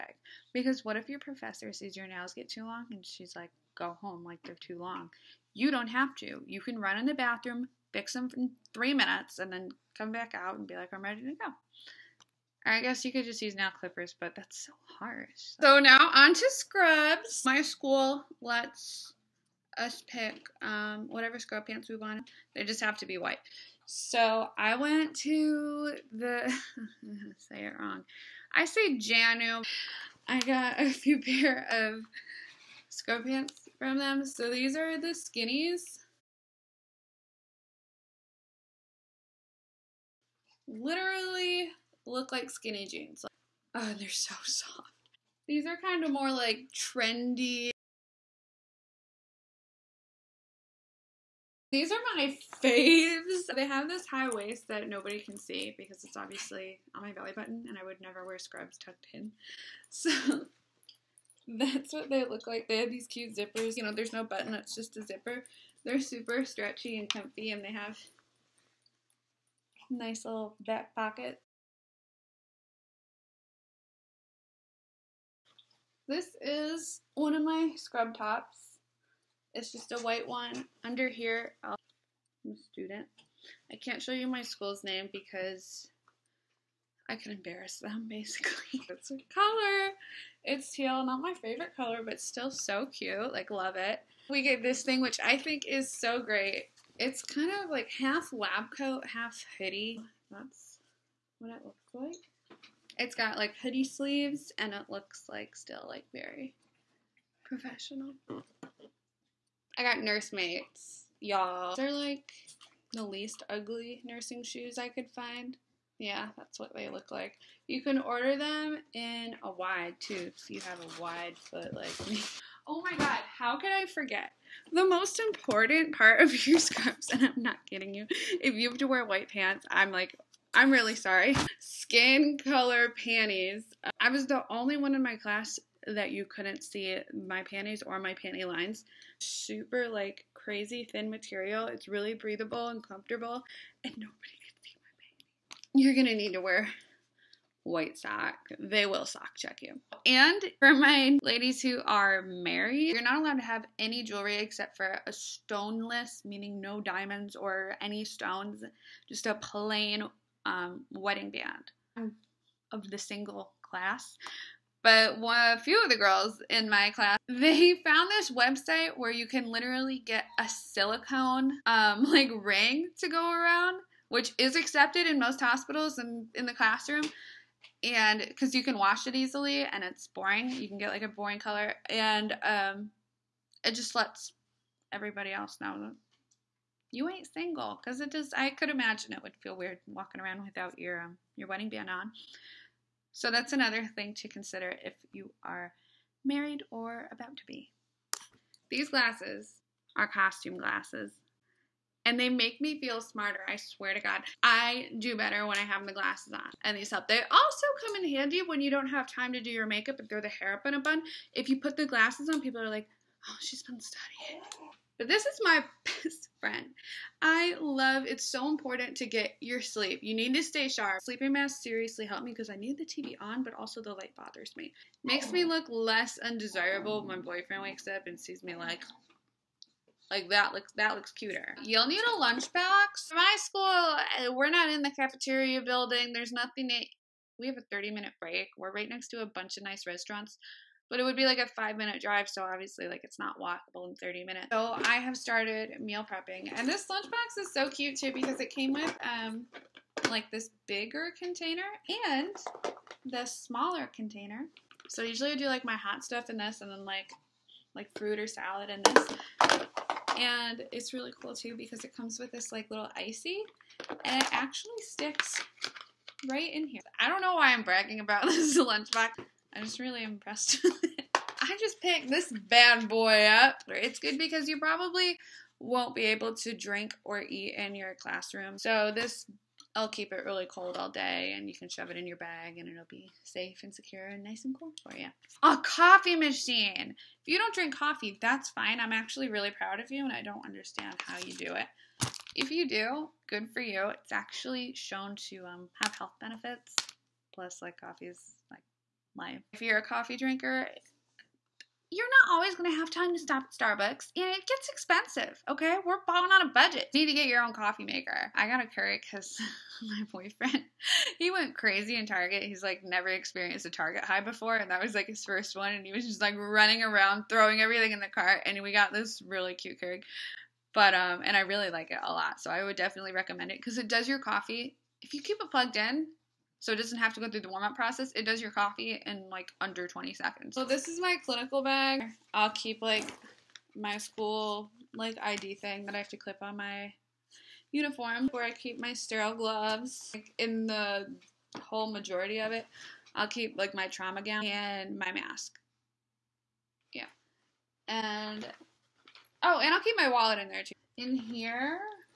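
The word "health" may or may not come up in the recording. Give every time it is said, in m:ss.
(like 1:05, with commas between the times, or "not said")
4:55.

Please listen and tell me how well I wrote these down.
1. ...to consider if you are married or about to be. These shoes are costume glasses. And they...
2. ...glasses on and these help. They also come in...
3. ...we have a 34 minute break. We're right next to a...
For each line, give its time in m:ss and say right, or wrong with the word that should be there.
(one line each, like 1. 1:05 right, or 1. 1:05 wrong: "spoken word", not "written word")
1. 3:14 wrong: "glasses", not "shoes"
2. 3:25 right
3. 3:57 wrong: "30", not "34".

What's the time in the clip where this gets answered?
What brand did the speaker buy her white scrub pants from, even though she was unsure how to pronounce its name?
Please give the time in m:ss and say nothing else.
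0:28.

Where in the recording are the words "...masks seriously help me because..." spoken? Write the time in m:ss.
3:41.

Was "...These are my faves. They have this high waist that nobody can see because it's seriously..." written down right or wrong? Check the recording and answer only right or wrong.
wrong.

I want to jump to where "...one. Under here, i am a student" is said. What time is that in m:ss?
1:20.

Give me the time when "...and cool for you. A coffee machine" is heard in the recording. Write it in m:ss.
4:44.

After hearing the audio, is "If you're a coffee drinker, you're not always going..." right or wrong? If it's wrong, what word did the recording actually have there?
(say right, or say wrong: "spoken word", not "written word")
right.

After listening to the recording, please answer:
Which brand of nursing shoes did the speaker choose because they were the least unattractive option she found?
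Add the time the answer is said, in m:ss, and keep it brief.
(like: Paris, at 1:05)
Nursemates, at 1:50.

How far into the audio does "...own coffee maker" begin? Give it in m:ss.
5:07.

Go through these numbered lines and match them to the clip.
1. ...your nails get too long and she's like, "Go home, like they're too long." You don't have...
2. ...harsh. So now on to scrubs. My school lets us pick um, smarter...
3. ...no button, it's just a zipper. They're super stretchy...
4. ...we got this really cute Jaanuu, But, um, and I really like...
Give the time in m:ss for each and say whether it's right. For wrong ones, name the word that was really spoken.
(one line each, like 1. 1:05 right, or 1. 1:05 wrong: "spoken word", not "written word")
1. 0:01 right
2. 0:14 wrong: "whatever", not "smarter"
3. 1:04 right
4. 5:18 wrong: "Keurig", not "Jaanuu".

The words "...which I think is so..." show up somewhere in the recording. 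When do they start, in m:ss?
1:35.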